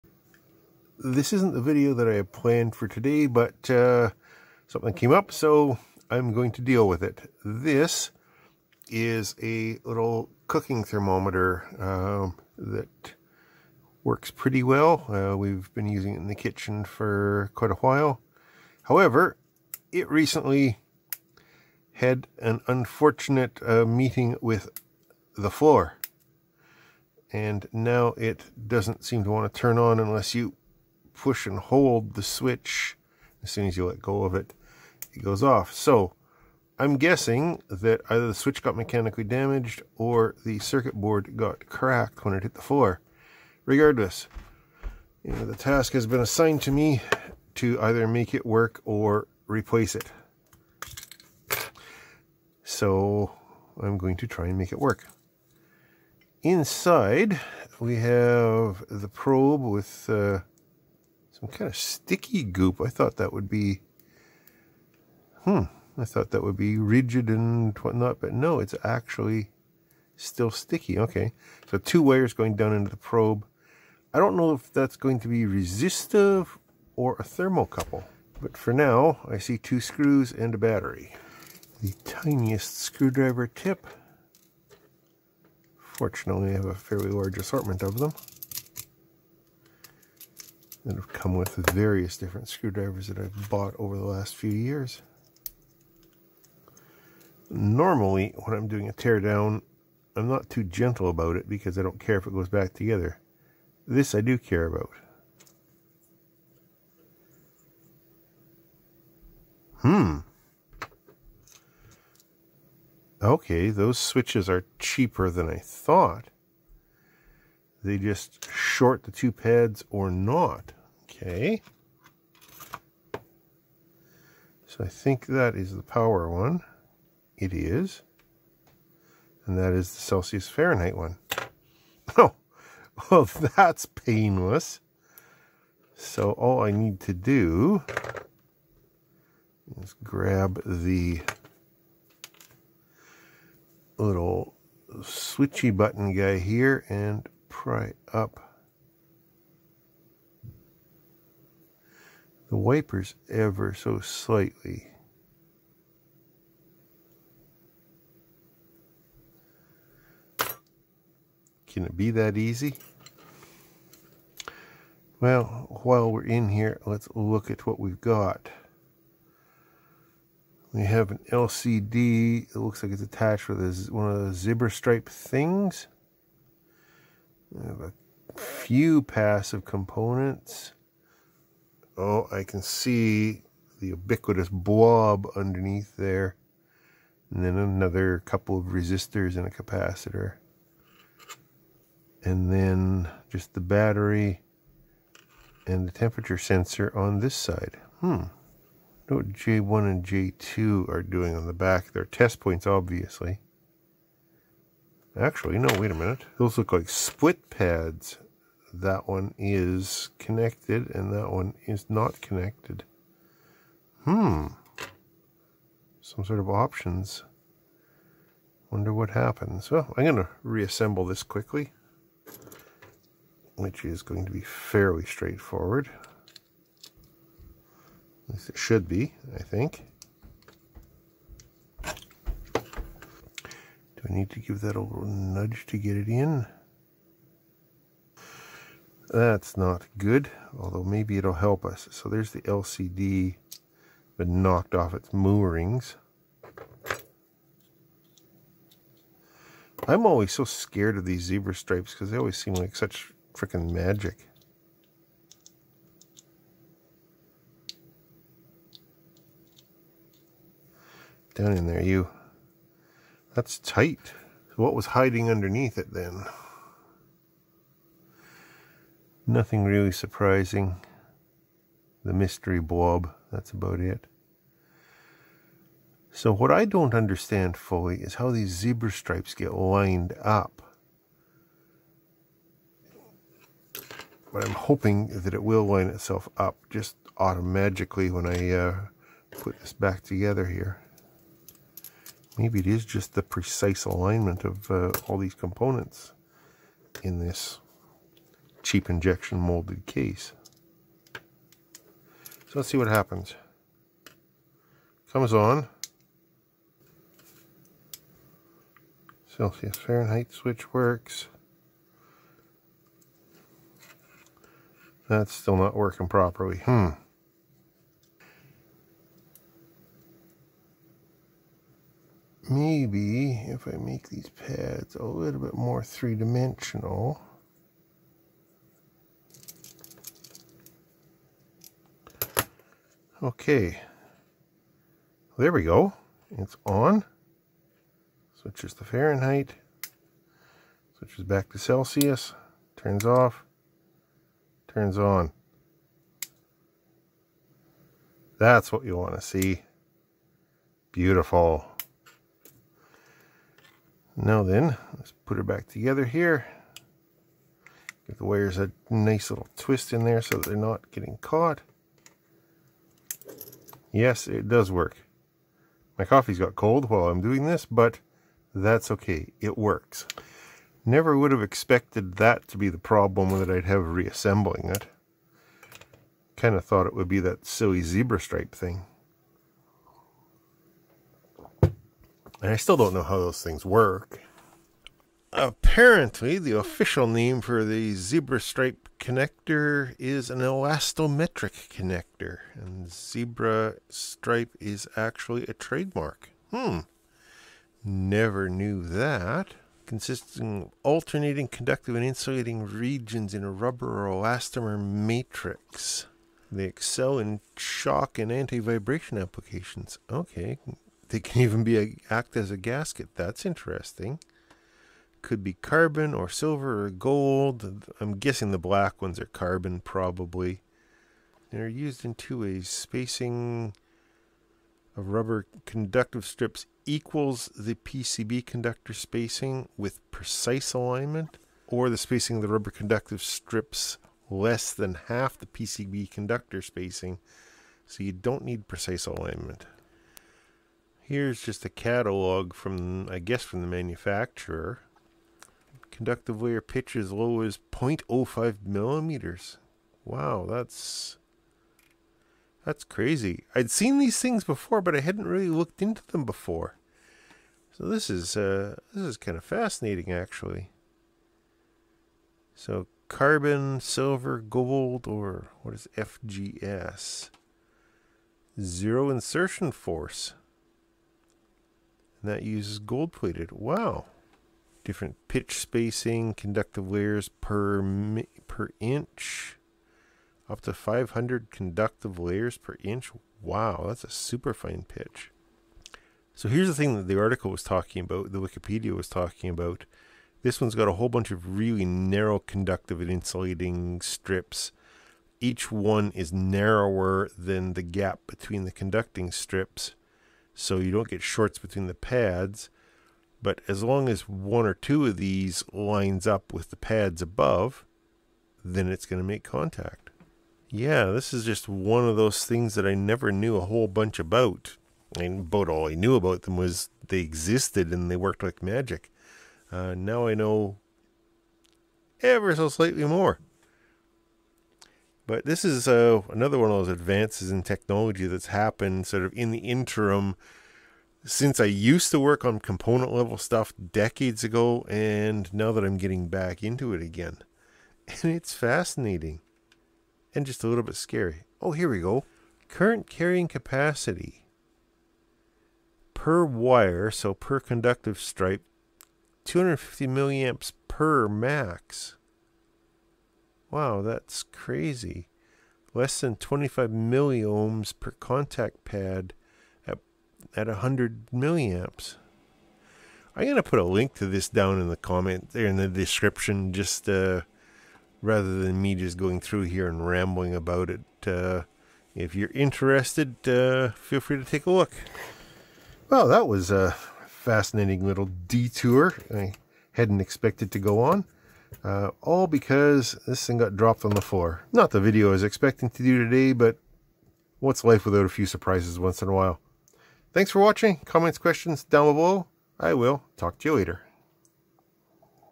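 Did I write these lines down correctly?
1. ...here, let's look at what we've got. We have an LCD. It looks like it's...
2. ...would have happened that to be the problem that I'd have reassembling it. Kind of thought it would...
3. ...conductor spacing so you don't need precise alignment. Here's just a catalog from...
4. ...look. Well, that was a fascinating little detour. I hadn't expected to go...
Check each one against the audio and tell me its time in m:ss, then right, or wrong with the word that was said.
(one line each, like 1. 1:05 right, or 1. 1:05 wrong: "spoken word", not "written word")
1. 2:46 right
2. 6:11 wrong: "expected", not "happened"
3. 7:16 right
4. 9:34 right.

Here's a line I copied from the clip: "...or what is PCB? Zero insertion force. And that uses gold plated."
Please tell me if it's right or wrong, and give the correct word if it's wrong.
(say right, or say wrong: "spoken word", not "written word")
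wrong: "FGS", not "PCB".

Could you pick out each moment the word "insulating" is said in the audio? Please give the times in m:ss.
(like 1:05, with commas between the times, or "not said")
6:42, 8:13.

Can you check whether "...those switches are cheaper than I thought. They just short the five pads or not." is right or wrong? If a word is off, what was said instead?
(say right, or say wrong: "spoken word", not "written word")
wrong: "two", not "five".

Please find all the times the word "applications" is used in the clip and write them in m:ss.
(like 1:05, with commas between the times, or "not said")
6:49.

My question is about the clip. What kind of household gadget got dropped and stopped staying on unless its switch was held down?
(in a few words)
cooking thermometer.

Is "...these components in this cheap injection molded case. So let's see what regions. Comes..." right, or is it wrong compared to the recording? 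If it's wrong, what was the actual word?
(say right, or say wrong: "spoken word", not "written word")
wrong: "happens", not "regions".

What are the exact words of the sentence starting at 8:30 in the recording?
Yeah, this is just one of those things that I never knew a whole bunch about.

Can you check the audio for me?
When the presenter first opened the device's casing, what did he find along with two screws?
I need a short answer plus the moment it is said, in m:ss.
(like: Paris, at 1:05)
a battery, at 1:20.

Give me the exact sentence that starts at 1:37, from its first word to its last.
Normally, when I'm doing a teardown, I'm not too gentle about it because I don't care if it goes back together.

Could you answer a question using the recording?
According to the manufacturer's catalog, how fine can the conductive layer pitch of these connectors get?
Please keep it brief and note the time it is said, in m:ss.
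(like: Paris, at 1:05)
0.05 millimeters, at 7:27.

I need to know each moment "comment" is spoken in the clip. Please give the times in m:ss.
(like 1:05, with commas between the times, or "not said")
9:24, 9:51.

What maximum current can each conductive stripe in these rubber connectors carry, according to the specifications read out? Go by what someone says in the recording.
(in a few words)
250 milliamps.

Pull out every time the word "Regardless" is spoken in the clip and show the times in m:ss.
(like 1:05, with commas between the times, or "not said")
0:43.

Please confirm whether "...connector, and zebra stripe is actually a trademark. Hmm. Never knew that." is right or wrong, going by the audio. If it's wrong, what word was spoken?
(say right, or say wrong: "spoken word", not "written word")
right.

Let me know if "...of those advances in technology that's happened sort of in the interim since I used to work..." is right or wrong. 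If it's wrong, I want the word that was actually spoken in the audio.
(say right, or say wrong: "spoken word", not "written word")
right.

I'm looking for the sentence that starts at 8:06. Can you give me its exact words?
So here's the thing that the article was talking about, the Wikipedia was talking about.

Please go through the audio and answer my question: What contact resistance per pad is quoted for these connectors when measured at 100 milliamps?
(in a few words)
less than 25 milliohms.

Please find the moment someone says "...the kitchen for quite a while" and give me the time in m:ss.
0:16.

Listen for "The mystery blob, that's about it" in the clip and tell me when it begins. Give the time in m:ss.
4:32.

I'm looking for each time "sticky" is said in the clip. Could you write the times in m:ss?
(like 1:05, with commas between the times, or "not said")
1:01, 1:10.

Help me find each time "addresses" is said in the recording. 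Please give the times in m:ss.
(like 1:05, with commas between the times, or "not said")
not said.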